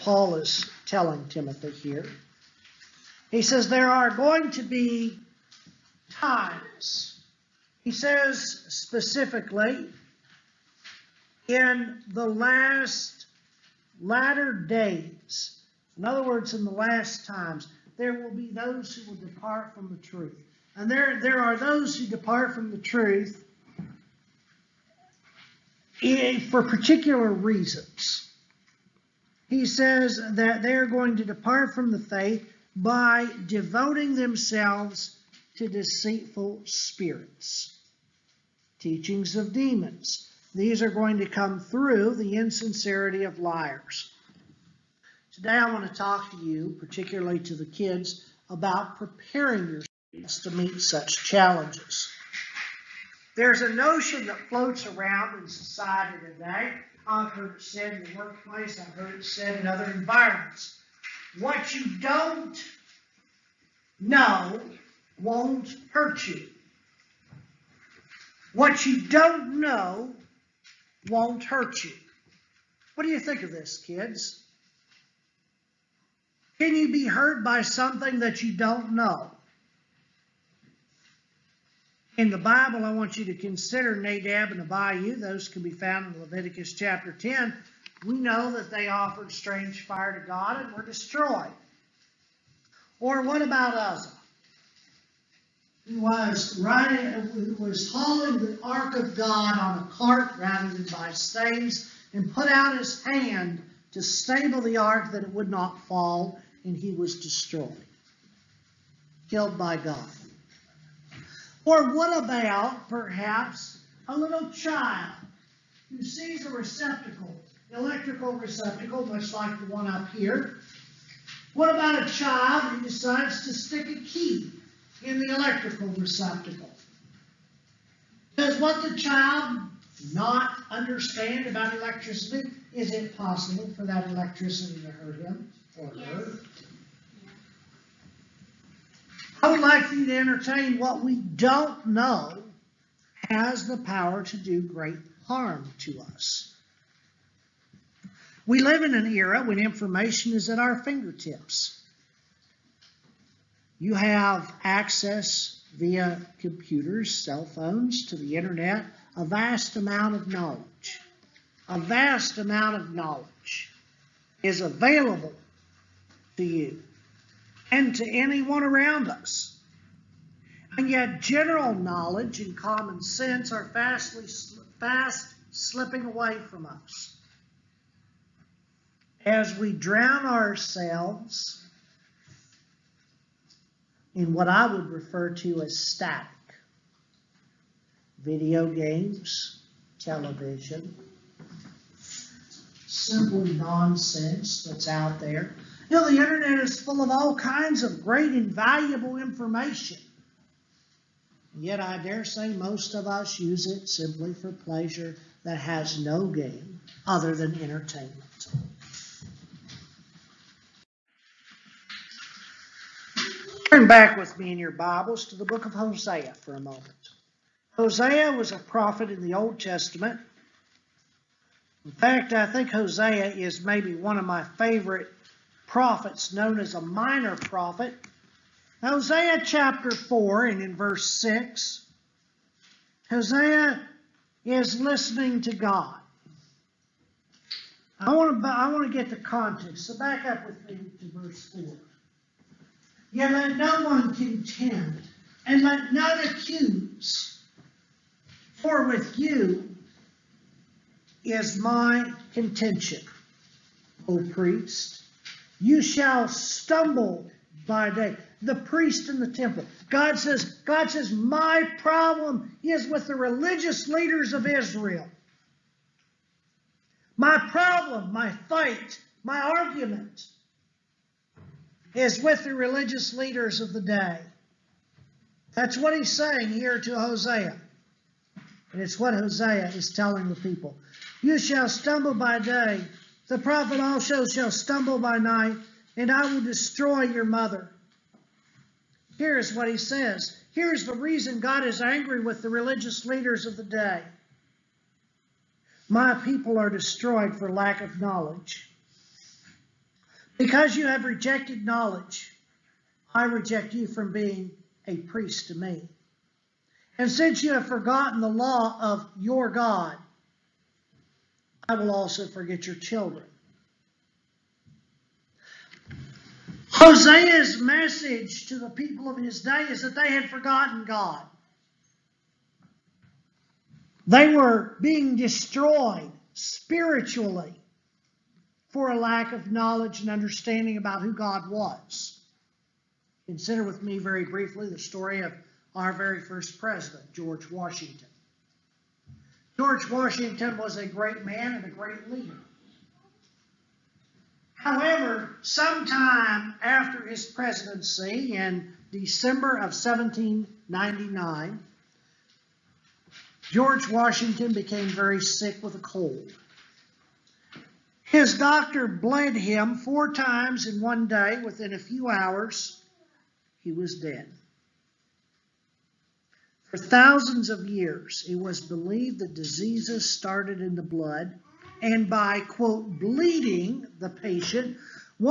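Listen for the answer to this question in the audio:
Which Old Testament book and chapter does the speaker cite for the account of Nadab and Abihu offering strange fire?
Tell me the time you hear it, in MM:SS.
01:26.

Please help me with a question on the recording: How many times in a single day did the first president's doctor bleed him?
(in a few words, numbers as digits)
4.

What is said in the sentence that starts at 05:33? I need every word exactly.
Consider with me very briefly the story of our very first president, George Washington.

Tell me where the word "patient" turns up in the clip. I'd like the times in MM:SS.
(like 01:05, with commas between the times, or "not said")
06:14.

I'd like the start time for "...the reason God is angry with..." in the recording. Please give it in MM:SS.
04:50.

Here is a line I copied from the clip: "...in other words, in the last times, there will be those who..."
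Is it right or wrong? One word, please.
right.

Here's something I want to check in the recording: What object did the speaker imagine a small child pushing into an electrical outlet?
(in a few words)
A key.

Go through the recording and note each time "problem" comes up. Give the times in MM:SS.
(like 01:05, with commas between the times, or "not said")
04:21, 04:27.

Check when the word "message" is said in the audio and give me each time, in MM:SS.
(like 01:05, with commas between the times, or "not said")
05:17.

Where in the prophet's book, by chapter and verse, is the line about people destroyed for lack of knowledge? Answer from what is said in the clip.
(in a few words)
Chapter 4, verse 6.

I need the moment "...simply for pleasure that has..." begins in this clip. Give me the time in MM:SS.
03:23.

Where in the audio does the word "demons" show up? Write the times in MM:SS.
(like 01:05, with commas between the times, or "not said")
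00:39.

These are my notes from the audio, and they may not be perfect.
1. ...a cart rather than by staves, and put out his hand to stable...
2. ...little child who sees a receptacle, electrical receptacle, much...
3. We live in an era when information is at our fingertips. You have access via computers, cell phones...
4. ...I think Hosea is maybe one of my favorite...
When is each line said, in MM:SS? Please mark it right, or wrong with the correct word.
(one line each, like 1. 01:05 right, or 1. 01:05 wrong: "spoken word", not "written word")
1. 01:39 right
2. 01:54 right
3. 02:28 right
4. 03:42 right.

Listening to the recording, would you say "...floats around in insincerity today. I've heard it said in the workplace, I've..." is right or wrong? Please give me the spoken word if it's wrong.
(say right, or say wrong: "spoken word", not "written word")
wrong: "society", not "insincerity".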